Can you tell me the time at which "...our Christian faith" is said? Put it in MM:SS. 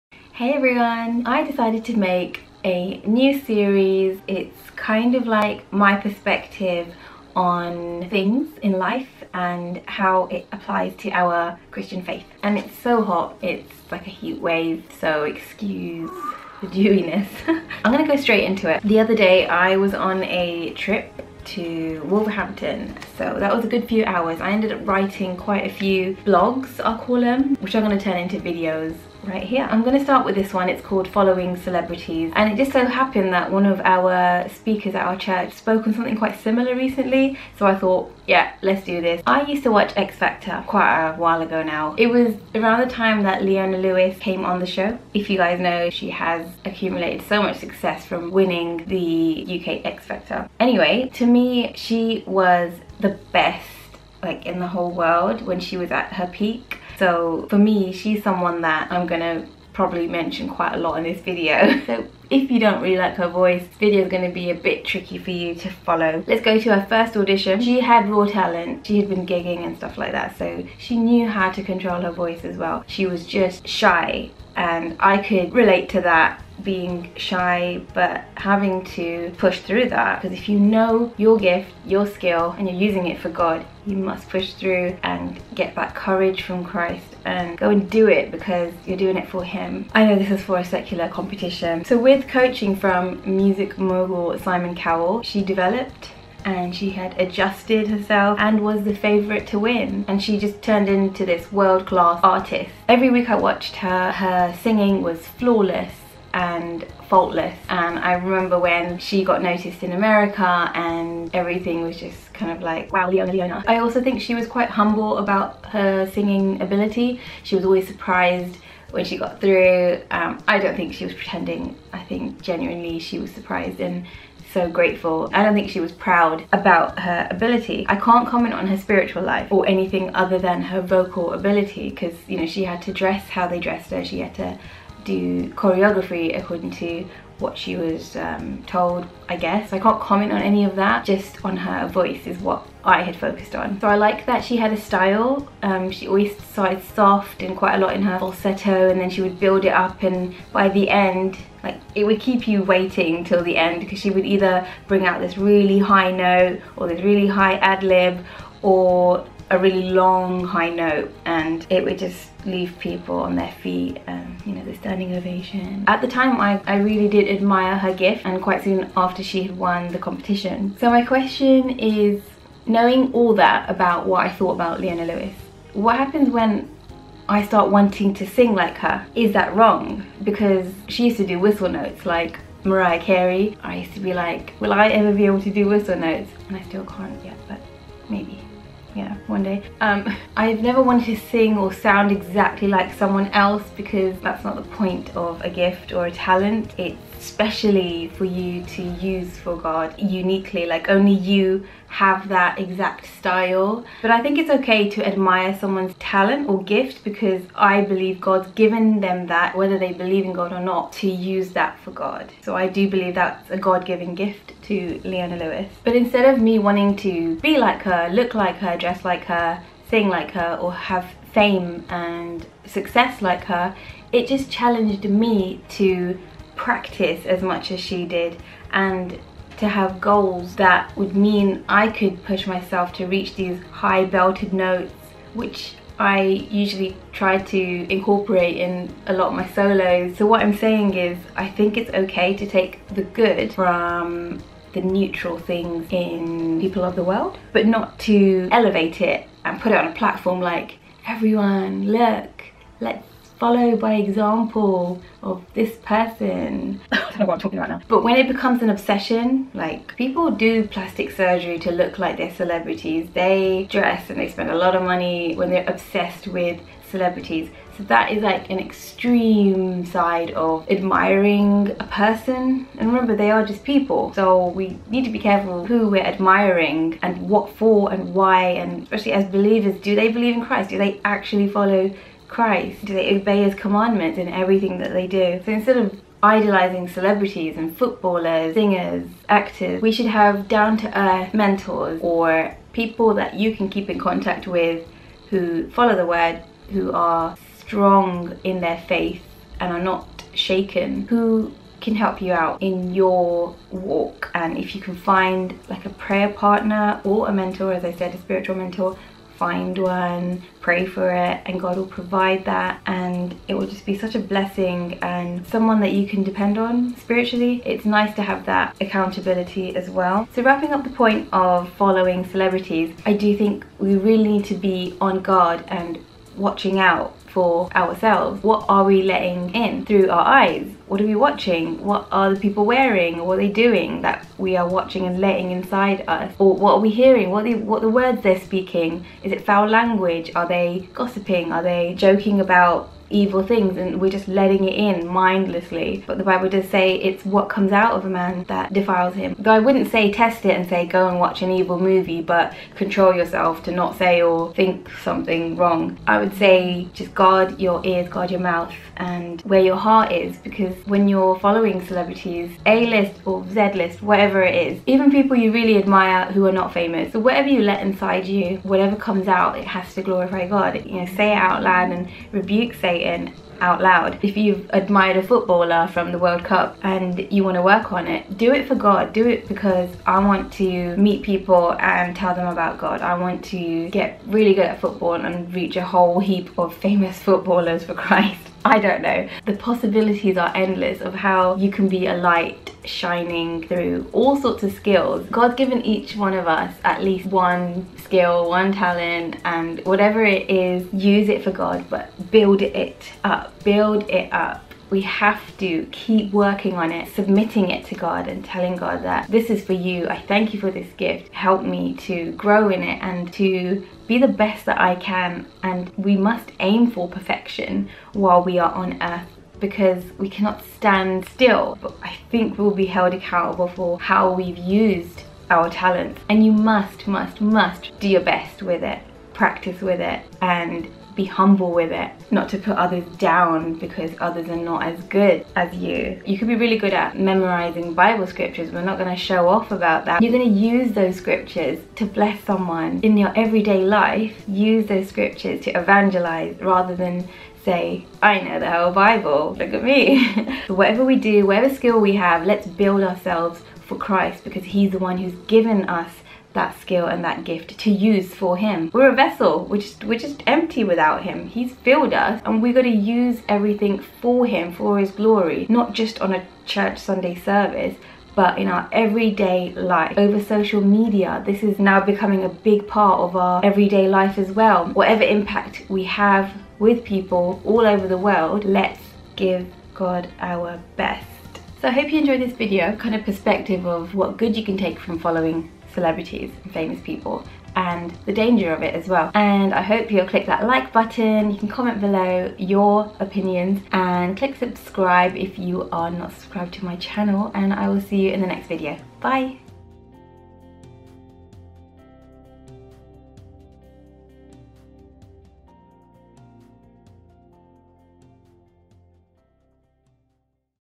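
00:11.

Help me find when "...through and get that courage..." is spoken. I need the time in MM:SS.
01:24.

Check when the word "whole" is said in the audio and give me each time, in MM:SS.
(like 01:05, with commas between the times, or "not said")
00:54, 06:25, 07:28.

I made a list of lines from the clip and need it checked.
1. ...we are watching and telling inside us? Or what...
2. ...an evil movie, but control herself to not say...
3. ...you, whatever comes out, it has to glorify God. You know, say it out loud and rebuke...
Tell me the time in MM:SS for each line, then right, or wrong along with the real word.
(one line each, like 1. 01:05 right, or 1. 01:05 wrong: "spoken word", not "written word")
1. 05:34 wrong: "letting", not "telling"
2. 05:51 wrong: "yourself", not "herself"
3. 06:08 right.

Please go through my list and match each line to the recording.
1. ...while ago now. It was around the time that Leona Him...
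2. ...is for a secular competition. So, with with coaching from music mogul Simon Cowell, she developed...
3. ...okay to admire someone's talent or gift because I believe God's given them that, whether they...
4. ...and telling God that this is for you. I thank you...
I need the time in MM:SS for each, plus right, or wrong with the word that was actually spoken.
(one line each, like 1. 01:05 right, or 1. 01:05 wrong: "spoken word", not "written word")
1. 00:41 wrong: "Lewis", not "Him"
2. 01:30 right
3. 03:24 right
4. 06:48 right.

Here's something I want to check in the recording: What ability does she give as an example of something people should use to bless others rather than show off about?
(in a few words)
memorizing Bible scriptures.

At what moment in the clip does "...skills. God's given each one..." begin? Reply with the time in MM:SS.
06:34.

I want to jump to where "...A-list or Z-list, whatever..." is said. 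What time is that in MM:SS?
06:02.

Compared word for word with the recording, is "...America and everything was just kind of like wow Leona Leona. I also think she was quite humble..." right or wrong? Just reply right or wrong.
right.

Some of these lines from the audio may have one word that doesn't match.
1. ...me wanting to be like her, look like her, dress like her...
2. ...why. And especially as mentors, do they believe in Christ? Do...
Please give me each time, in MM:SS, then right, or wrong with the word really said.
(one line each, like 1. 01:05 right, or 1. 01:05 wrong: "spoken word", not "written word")
1. 03:36 right
2. 04:38 wrong: "believers", not "mentors".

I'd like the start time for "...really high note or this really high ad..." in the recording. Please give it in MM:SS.
02:35.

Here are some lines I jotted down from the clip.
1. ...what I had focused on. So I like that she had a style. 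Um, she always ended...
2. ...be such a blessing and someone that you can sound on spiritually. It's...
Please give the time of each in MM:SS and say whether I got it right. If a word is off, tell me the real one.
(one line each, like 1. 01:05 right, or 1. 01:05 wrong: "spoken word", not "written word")
1. 02:22 wrong: "started", not "ended"
2. 05:13 wrong: "depend", not "sound".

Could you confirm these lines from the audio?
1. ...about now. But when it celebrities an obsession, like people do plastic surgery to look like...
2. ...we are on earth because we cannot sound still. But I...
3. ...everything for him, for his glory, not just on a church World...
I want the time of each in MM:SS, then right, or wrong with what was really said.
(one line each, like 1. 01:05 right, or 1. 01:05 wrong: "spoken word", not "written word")
1. 04:17 wrong: "becomes", not "celebrities"
2. 06:58 wrong: "stand", not "sound"
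3. 07:43 wrong: "Sunday", not "World".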